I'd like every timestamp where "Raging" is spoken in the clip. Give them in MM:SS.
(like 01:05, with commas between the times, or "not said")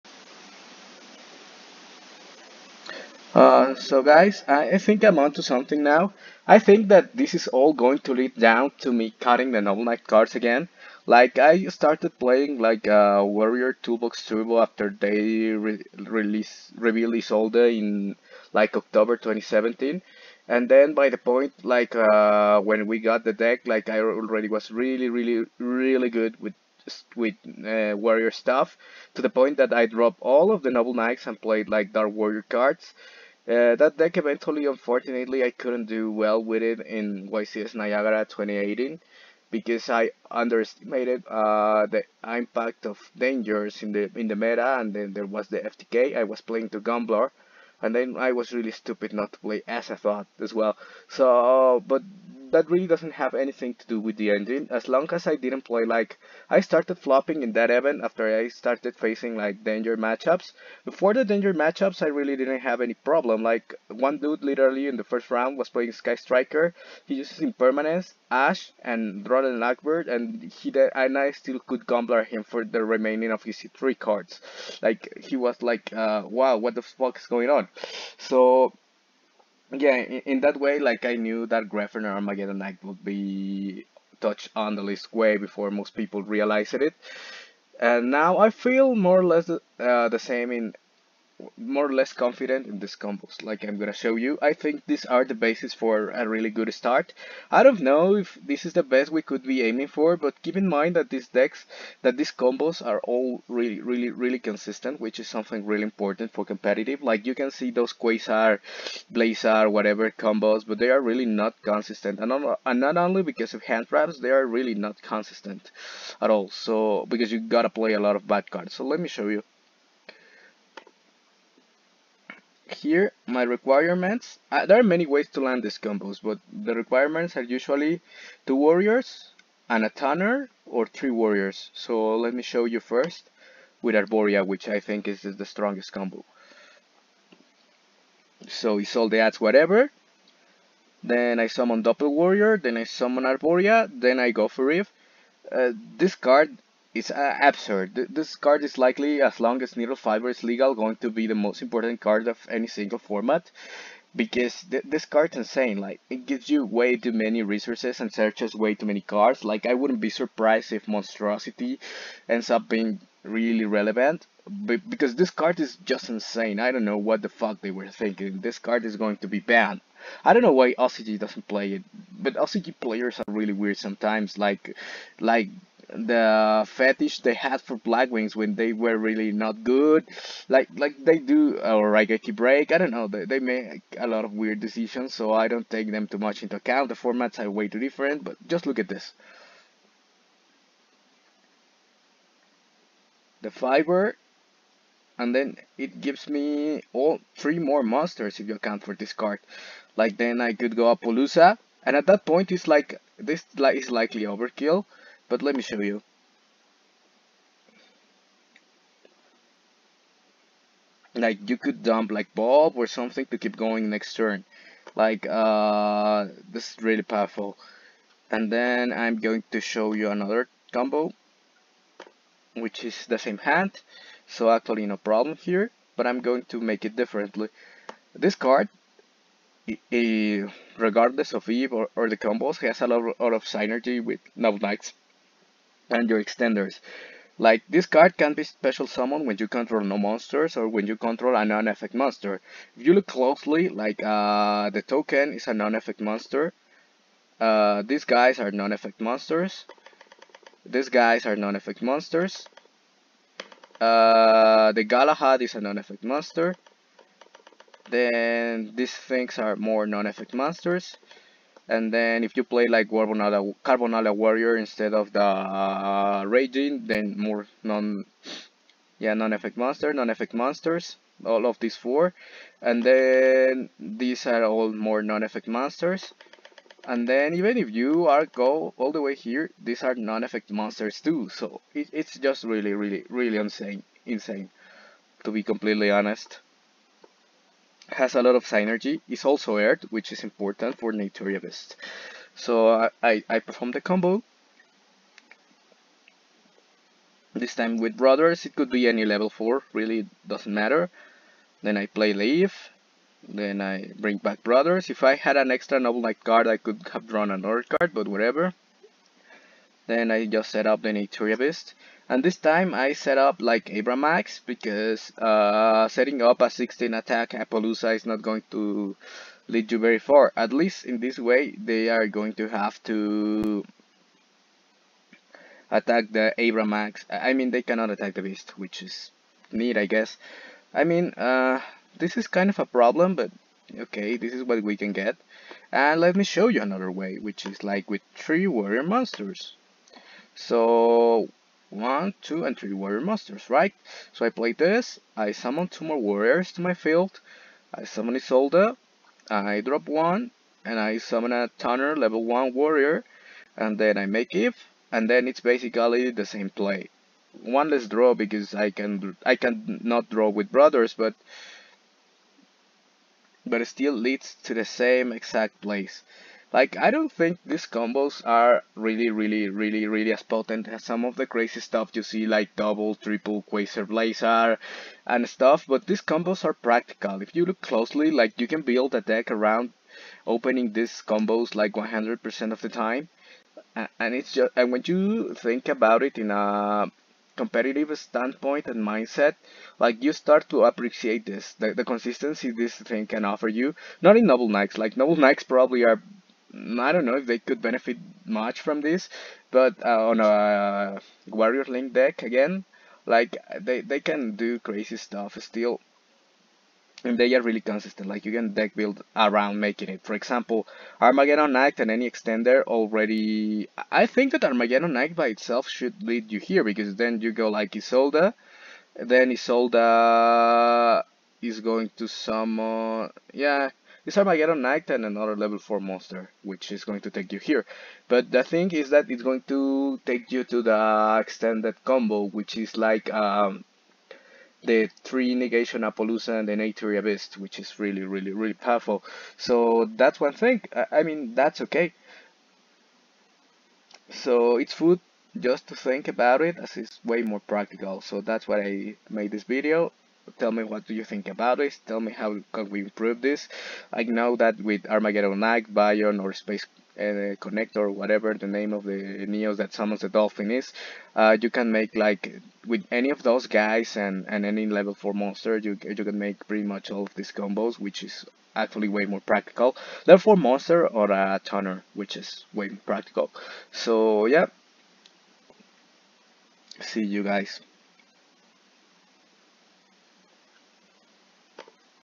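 04:26.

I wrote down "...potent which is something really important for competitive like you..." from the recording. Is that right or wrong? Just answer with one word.
wrong.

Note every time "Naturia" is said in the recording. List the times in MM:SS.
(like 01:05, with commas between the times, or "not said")
04:50, 05:10, 07:16.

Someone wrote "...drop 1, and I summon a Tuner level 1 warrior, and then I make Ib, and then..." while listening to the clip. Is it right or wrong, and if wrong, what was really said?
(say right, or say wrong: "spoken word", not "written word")
right.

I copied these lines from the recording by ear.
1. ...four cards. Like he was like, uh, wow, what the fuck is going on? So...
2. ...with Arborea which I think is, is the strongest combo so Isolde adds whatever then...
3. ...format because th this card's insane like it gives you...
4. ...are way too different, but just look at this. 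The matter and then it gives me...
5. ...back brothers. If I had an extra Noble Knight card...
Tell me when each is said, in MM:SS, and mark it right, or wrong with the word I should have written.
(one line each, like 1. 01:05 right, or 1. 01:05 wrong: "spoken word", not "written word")
1. 01:13 wrong: "three", not "four"
2. 02:13 right
3. 02:32 right
4. 03:07 wrong: "fiber", not "matter"
5. 05:04 right.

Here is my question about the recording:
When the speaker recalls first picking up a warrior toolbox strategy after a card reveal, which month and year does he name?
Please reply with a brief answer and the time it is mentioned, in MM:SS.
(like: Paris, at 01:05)
October 2017, at 00:18.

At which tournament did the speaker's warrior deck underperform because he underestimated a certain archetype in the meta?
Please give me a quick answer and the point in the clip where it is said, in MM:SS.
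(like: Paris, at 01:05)
YCS Niagara 2018, at 00:37.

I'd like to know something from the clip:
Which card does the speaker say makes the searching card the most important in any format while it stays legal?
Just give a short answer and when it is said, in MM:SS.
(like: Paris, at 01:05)
Needlefiber, at 02:29.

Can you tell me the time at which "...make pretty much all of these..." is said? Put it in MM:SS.
07:46.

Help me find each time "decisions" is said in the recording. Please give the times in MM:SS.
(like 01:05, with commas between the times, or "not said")
03:04.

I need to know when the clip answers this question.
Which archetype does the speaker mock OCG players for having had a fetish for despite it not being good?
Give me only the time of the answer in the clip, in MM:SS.
02:57.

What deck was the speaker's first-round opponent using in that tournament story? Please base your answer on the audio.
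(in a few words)
Sky Striker.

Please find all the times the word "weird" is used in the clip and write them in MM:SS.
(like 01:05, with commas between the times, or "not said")
02:53, 03:04.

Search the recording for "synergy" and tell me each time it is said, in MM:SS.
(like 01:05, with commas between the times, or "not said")
03:53, 04:48.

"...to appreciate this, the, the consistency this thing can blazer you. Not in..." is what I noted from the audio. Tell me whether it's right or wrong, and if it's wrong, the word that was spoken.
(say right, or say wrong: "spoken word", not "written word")
wrong: "offer", not "blazer".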